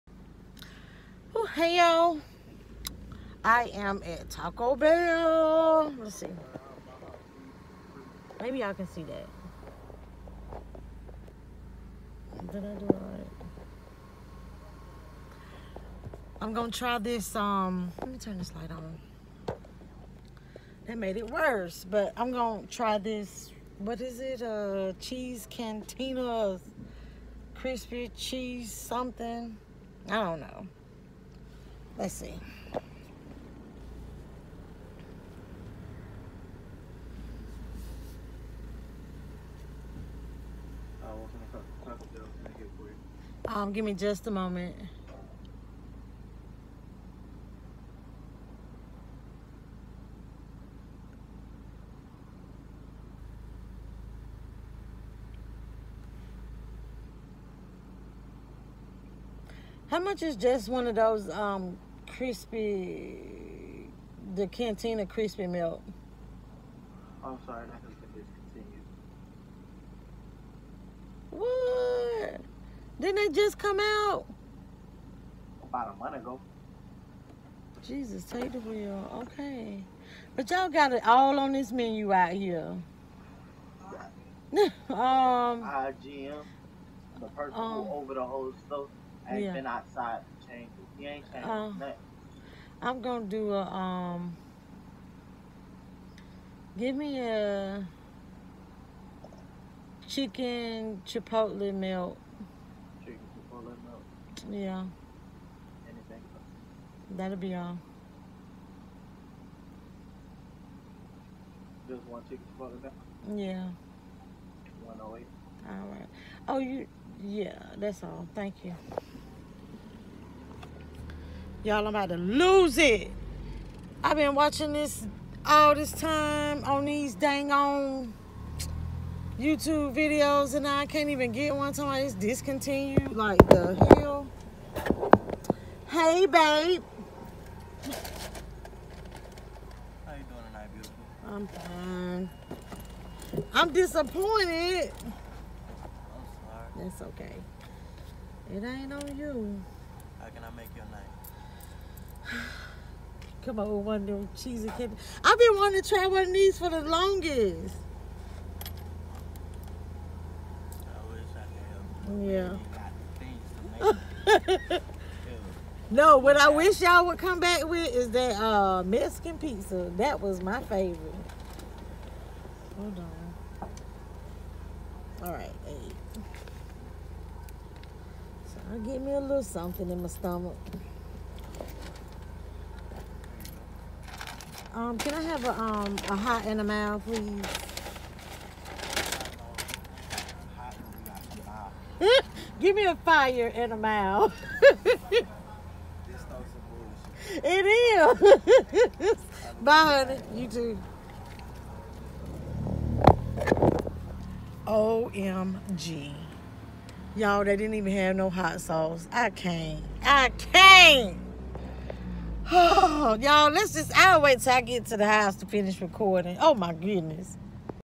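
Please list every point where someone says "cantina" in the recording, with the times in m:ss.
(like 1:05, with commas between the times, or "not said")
0:25, 1:04.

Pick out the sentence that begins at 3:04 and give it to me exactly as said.
Um, can I have a, um, a hot in a mouth, please?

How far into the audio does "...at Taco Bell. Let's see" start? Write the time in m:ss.
0:04.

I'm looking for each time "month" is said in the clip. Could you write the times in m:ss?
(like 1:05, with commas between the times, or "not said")
1:16.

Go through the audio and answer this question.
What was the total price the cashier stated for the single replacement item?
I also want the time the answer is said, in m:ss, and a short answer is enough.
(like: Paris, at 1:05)
1.08, at 1:54.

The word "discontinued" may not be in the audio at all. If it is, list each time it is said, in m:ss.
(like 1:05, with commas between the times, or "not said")
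1:08, 2:12.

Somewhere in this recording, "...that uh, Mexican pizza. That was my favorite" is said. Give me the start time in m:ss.
2:48.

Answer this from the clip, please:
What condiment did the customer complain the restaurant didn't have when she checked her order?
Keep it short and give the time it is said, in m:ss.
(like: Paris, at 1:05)
Hot sauce, at 3:28.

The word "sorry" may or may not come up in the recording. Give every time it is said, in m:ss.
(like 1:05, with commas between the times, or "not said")
1:07, 2:26.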